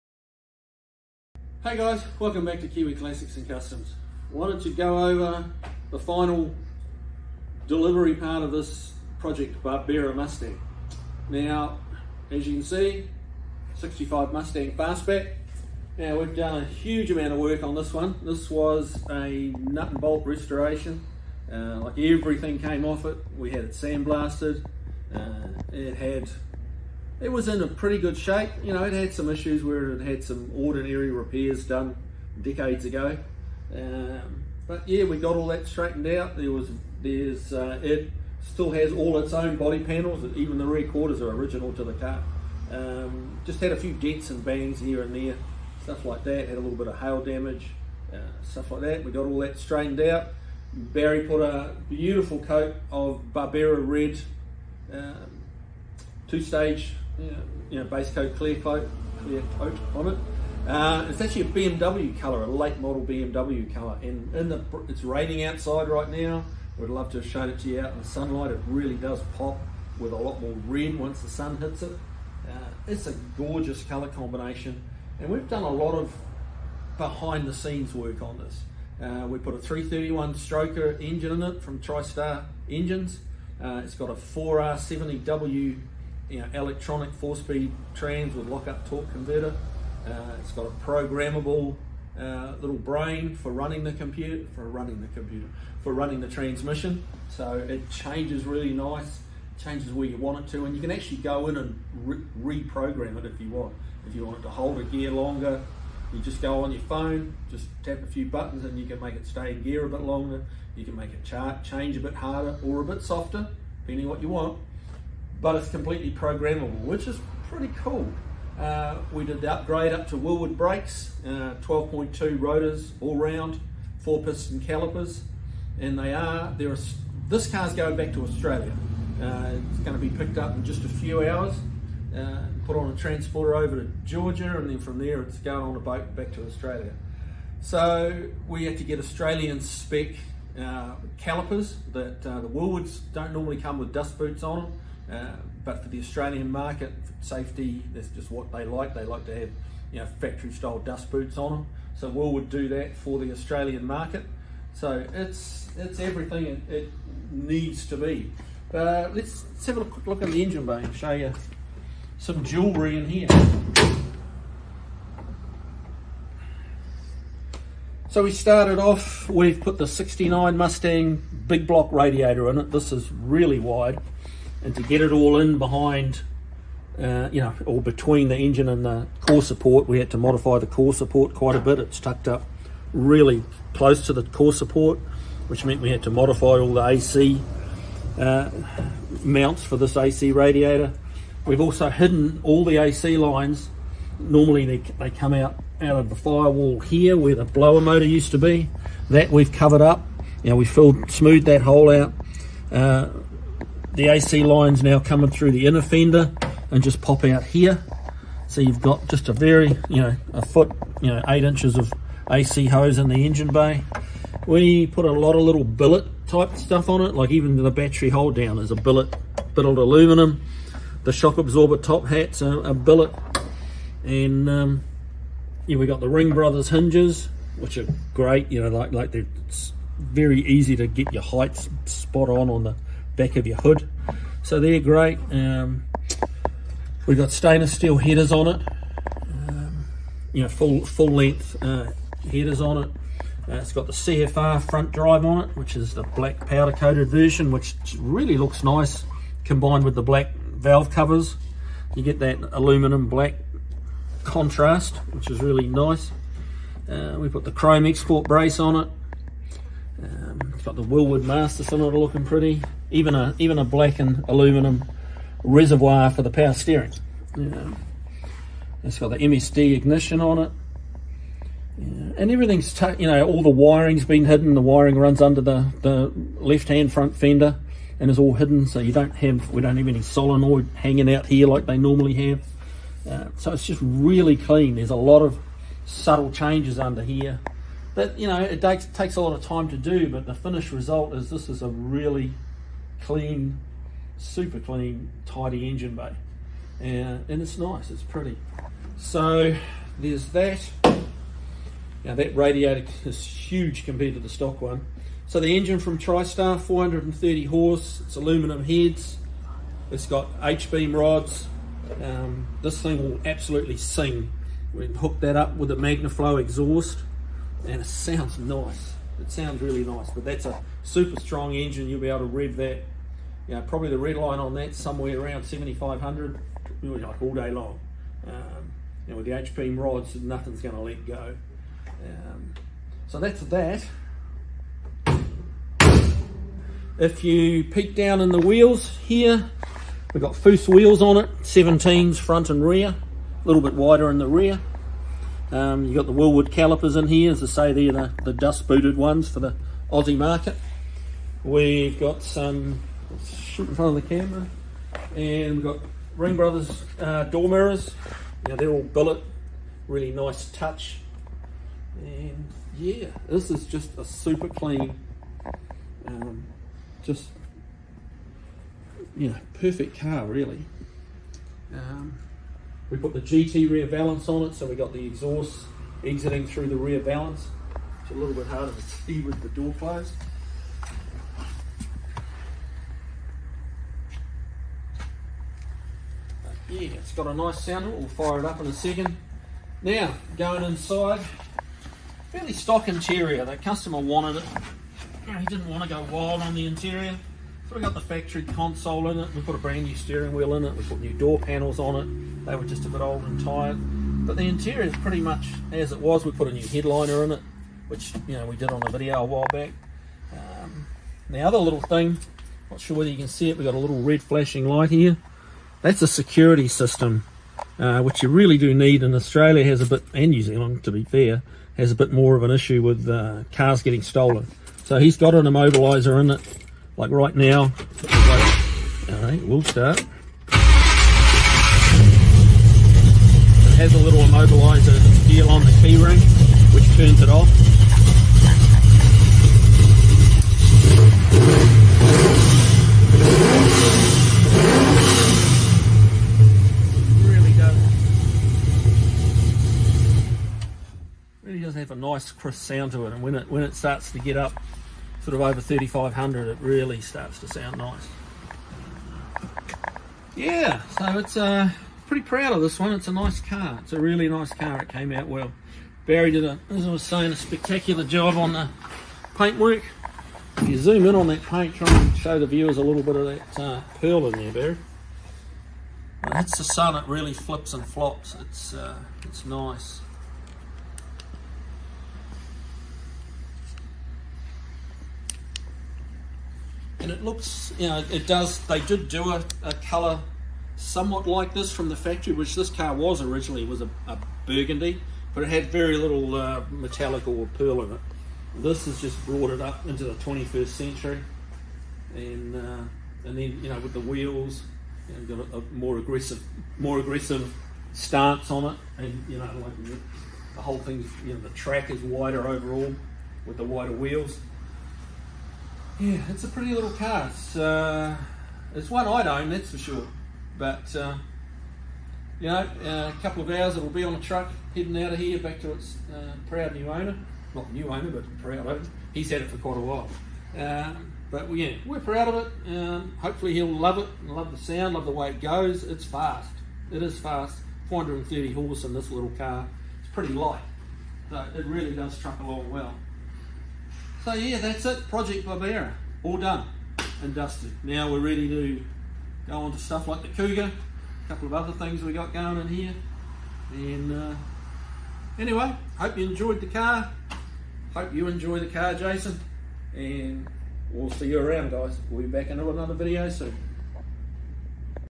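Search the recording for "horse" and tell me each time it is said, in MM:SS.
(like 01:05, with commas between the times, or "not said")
05:07, 08:58.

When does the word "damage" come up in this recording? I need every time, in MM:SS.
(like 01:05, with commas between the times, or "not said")
00:47.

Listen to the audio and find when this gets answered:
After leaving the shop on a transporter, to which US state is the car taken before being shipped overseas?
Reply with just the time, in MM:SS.
02:14.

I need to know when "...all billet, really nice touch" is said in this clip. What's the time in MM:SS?
05:58.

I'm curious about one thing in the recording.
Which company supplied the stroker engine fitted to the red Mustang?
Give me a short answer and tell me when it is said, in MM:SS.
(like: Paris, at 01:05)
TriStar Engines, at 01:21.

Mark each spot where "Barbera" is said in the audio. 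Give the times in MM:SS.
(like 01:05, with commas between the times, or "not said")
00:09, 00:53, 09:05.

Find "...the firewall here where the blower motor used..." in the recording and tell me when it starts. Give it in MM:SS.
03:16.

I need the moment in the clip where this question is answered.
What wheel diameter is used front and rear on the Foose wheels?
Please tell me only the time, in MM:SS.
05:41.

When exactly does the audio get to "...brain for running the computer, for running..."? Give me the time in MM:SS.
01:32.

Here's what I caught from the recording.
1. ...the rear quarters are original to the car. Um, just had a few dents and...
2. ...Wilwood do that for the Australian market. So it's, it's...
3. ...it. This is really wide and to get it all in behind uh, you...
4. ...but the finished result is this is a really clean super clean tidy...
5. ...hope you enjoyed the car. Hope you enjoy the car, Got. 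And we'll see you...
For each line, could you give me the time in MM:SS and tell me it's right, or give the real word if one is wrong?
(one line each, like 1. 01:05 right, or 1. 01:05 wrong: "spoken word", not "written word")
1. 00:40 right
2. 02:32 right
3. 02:52 right
4. 04:50 right
5. 09:15 wrong: "Jason", not "Got".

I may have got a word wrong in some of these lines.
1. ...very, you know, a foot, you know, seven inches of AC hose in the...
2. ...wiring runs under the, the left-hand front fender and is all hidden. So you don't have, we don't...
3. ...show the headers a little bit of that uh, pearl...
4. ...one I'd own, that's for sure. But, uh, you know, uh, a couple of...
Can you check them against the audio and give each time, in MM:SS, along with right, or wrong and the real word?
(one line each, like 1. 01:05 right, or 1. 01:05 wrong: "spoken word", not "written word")
1. 03:29 wrong: "eight", not "seven"
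2. 04:34 right
3. 07:52 wrong: "viewers", not "headers"
4. 08:38 right.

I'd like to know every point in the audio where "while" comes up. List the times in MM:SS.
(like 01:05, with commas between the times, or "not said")
06:49, 08:49.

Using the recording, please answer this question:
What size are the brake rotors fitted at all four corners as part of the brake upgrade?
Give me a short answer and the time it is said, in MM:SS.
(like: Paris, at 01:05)
12.2, at 02:01.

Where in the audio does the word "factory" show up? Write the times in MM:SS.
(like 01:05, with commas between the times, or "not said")
02:30, 06:38, 08:11.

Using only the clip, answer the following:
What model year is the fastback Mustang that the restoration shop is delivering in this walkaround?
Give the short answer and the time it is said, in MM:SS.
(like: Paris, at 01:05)
1965, at 00:13.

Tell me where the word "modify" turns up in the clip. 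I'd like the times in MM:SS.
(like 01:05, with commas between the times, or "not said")
03:00, 03:06.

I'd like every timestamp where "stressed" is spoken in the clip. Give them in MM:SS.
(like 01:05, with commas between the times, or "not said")
not said.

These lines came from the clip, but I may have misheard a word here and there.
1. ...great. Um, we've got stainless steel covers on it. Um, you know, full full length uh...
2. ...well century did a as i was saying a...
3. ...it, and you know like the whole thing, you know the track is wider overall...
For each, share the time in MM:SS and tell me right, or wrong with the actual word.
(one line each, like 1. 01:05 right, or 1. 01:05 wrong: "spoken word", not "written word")
1. 03:54 wrong: "headers", not "covers"
2. 07:45 wrong: "barry", not "century"
3. 08:28 right.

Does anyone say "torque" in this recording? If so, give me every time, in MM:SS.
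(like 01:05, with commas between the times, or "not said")
01:28.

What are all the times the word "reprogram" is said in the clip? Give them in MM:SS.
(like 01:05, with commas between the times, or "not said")
01:42.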